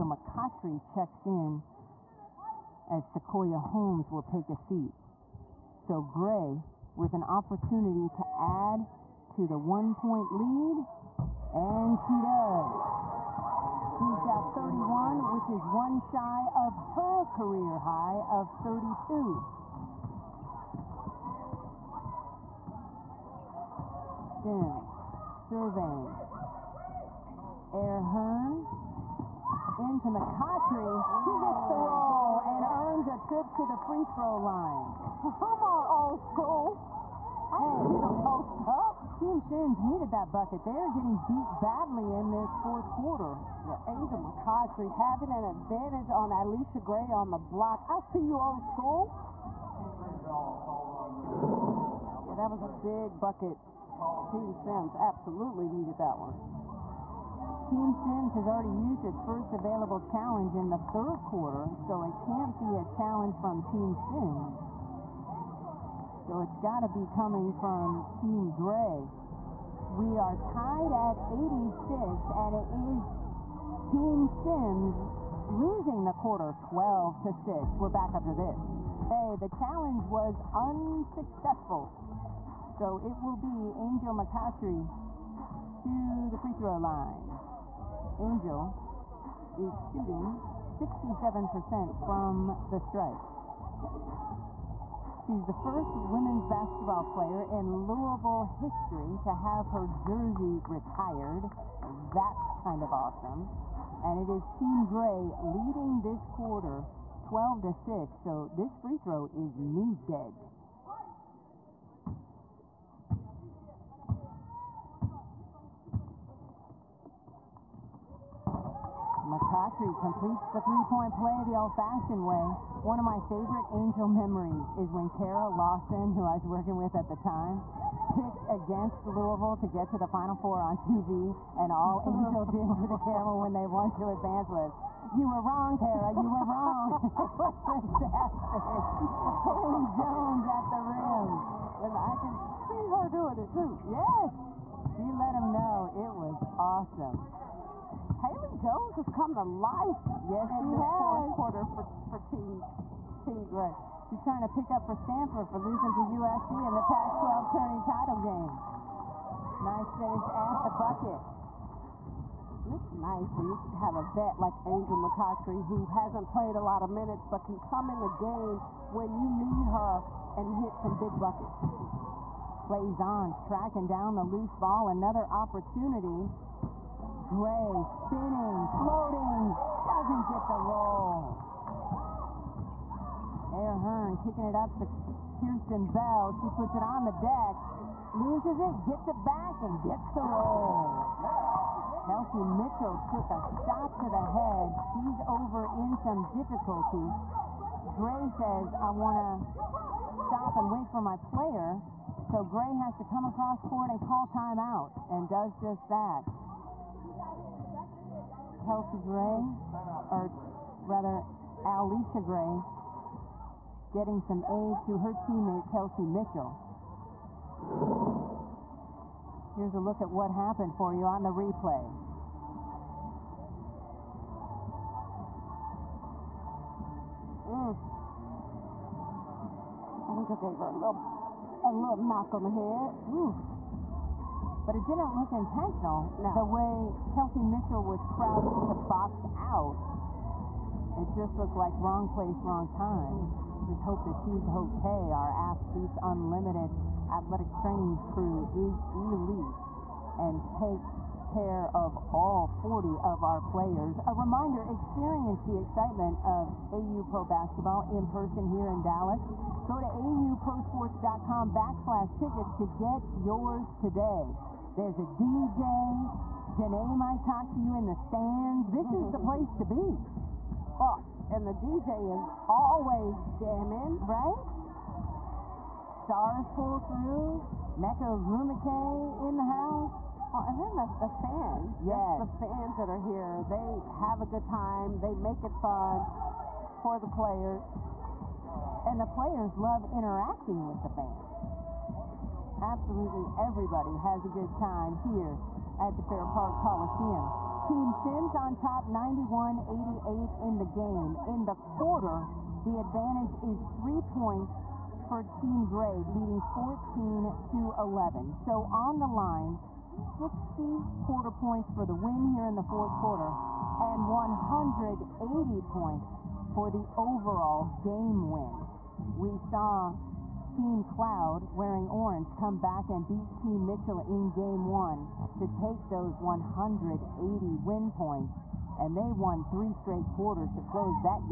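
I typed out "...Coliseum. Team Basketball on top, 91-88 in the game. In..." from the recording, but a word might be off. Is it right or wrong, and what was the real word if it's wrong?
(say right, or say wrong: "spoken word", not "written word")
wrong: "Sims", not "Basketball".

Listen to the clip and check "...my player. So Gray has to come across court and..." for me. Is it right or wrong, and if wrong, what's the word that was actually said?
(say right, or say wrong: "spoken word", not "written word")
right.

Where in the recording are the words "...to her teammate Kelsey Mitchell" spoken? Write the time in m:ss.
3:34.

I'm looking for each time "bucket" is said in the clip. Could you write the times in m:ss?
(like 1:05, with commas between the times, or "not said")
0:40, 0:53, 2:40, 2:51.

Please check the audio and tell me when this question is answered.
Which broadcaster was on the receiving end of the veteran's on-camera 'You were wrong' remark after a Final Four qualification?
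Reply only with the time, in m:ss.
2:05.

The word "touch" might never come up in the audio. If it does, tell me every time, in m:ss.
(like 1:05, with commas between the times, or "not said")
not said.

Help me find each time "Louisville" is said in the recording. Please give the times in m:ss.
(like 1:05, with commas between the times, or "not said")
1:37, 2:09.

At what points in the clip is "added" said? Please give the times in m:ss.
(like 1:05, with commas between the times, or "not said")
not said.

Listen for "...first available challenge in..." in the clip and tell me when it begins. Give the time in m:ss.
0:59.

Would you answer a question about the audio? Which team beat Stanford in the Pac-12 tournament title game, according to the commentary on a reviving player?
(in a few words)
USC.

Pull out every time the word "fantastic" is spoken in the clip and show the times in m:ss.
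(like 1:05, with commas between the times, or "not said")
2:17.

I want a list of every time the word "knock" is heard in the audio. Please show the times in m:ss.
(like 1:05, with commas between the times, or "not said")
3:52.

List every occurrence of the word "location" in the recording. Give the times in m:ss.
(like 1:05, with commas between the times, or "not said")
not said.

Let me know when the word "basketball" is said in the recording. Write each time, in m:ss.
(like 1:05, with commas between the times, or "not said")
1:36, 4:17.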